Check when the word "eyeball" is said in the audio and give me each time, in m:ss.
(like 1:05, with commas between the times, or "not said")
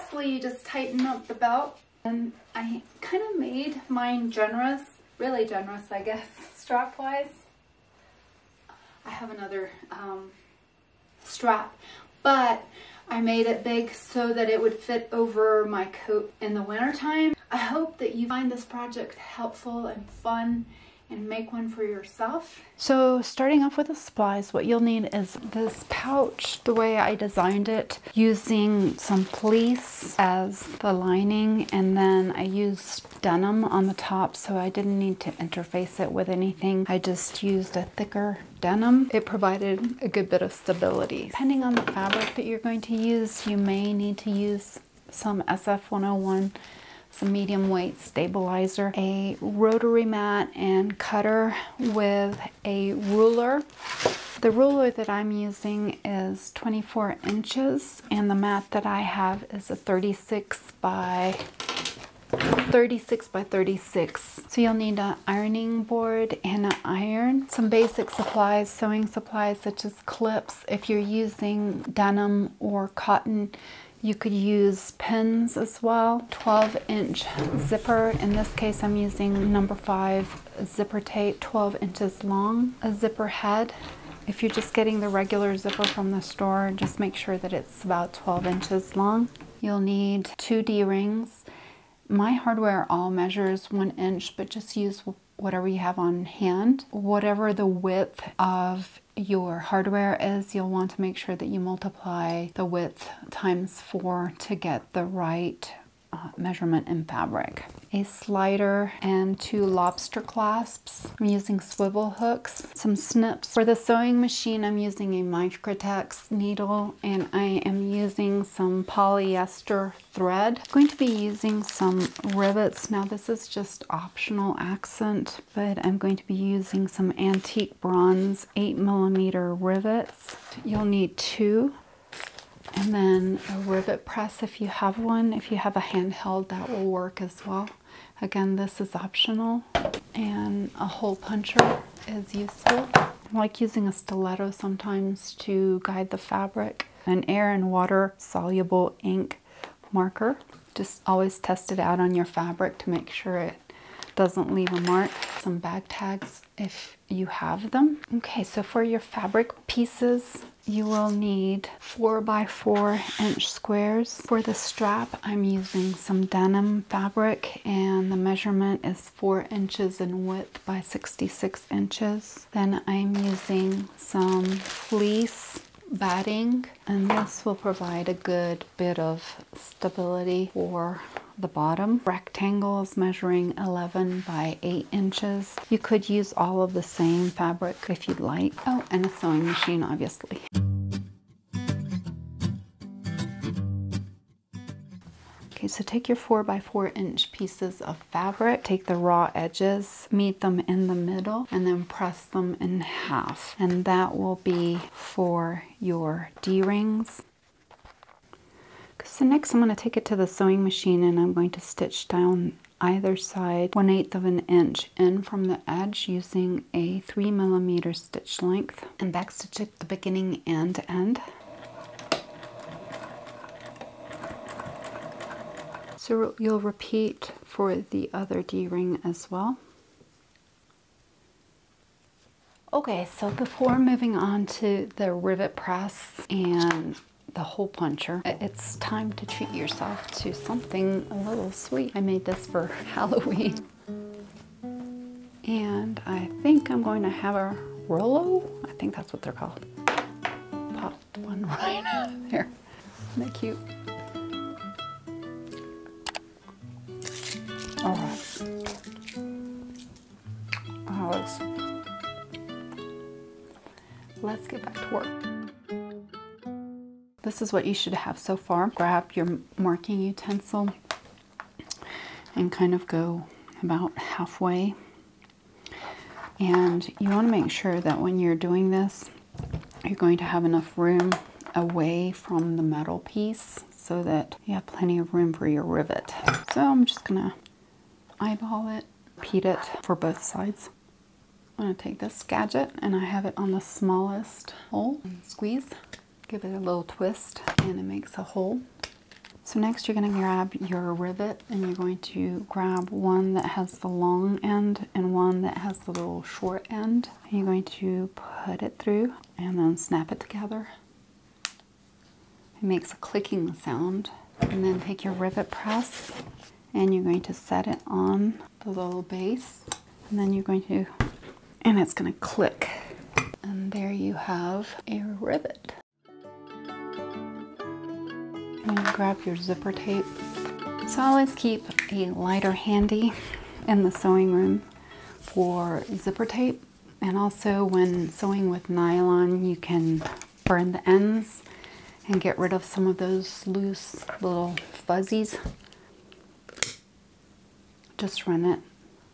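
4:48.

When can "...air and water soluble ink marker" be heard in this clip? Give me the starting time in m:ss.
2:27.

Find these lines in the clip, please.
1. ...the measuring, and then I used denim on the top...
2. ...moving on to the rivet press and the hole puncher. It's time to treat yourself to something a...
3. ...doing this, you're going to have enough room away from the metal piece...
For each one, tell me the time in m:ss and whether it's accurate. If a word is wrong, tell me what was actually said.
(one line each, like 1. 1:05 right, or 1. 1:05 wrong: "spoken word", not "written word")
1. 0:30 wrong: "lining", not "measuring"
2. 3:53 right
3. 4:38 right.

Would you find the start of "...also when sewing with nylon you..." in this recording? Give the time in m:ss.
5:37.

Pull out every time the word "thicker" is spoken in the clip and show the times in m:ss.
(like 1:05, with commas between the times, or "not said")
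0:37.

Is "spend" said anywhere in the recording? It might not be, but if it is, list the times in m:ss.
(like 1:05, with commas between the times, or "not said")
not said.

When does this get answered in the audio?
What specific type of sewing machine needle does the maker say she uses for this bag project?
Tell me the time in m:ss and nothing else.
1:55.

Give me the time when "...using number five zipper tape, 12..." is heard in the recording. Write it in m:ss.
1:18.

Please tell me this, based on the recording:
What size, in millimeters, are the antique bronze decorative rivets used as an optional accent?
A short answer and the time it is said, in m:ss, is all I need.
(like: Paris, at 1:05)
8, at 2:08.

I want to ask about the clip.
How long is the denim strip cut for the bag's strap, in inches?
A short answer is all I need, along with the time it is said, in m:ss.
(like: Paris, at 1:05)
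66, at 2:50.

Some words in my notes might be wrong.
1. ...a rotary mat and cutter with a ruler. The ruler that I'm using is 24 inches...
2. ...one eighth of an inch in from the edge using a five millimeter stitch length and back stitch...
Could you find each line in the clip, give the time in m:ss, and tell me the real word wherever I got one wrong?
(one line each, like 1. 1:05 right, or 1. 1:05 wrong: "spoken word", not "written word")
1. 0:48 right
2. 3:33 wrong: "three", not "five".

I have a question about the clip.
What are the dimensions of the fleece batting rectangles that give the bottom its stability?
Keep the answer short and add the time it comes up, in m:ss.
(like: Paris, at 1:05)
11 by 8 inches, at 3:03.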